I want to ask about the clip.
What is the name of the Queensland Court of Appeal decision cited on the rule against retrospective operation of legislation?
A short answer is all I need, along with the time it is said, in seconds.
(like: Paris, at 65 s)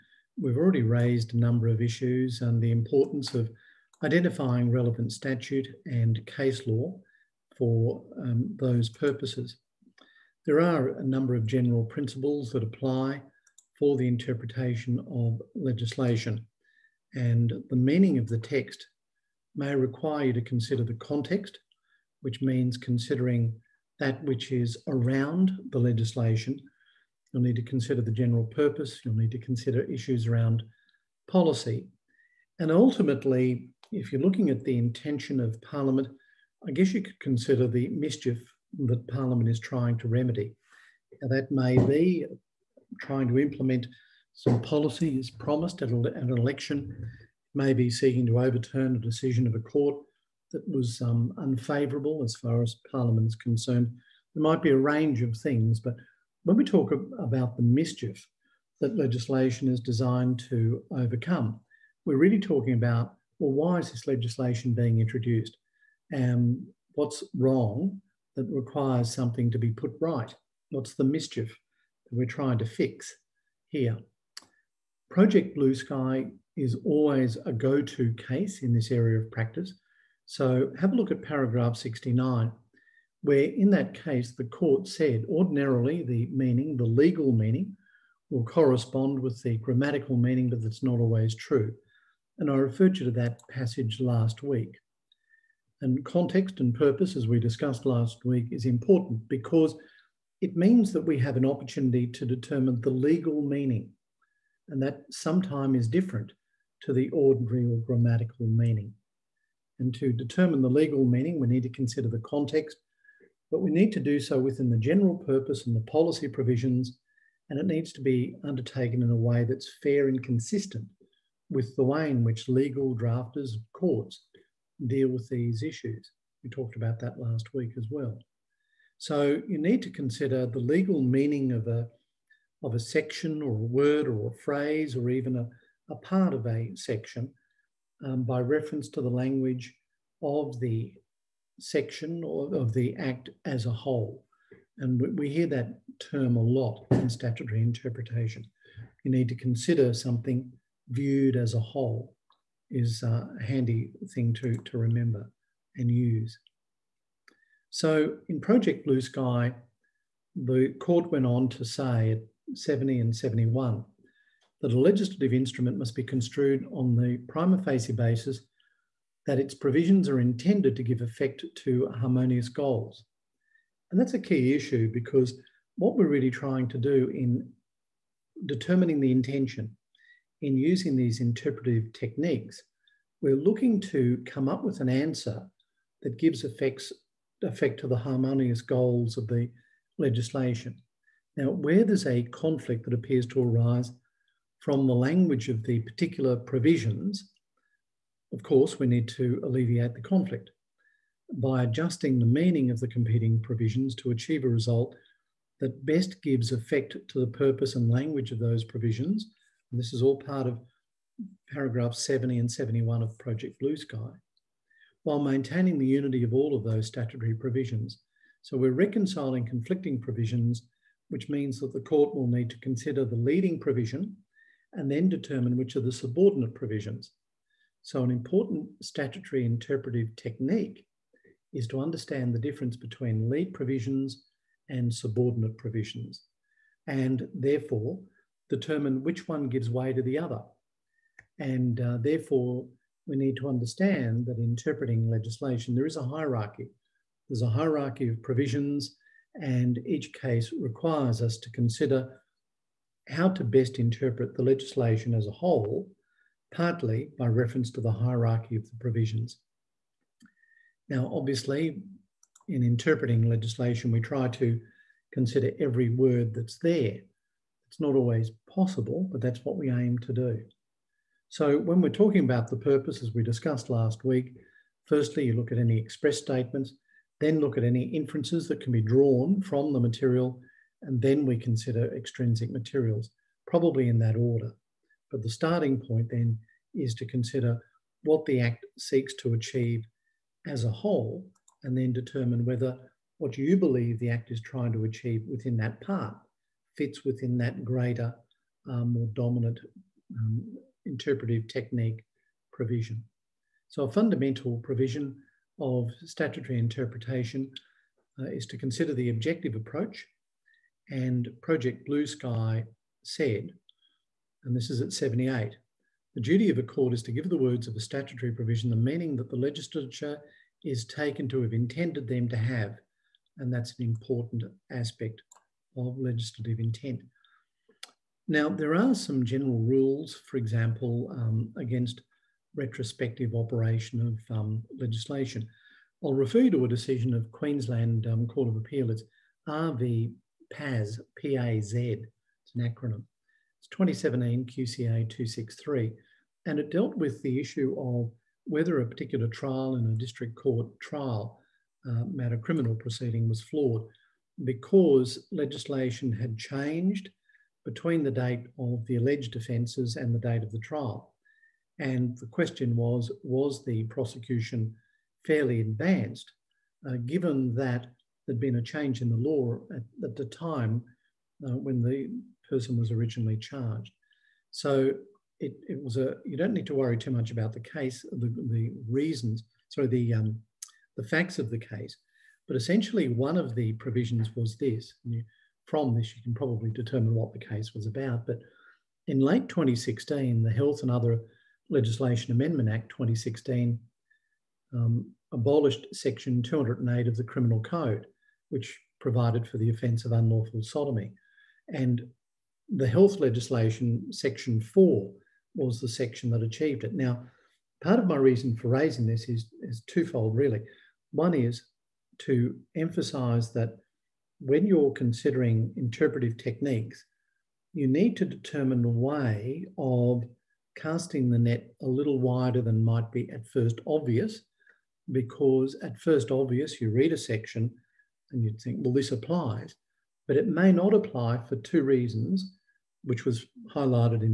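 R v PAZ, at 339 s.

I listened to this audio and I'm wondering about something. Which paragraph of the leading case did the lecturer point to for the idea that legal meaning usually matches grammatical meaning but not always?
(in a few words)
69.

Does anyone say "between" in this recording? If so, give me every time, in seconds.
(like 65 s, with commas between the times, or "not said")
232 s, 357 s.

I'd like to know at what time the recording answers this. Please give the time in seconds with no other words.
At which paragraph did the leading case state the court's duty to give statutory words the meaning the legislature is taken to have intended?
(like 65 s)
314 s.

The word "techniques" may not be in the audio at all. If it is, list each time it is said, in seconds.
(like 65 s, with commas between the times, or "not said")
181 s, 230 s, 301 s, 416 s.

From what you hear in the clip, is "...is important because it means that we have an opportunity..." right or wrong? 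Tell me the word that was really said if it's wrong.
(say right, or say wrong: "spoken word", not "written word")
right.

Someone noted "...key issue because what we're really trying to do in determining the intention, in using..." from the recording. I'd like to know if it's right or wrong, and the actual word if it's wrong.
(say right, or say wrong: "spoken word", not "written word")
right.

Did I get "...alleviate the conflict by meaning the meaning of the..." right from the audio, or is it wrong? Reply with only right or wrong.
wrong.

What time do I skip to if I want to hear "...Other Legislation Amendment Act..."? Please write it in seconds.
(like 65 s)
390 s.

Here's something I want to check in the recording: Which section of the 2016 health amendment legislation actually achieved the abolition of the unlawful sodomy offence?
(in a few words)
section four.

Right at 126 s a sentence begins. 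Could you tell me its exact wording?
We talked about that last week as well.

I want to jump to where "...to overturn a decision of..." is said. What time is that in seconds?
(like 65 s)
48 s.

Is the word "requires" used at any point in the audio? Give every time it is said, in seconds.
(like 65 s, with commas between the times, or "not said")
19 s, 68 s, 250 s.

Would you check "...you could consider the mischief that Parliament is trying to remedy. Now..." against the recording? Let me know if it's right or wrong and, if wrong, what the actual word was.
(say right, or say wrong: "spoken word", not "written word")
right.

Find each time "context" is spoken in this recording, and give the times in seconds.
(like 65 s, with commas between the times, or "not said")
20 s, 96 s, 112 s.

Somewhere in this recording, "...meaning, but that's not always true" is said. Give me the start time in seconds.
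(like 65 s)
90 s.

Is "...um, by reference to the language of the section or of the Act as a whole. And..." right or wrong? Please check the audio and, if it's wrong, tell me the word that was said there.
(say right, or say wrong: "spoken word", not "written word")
right.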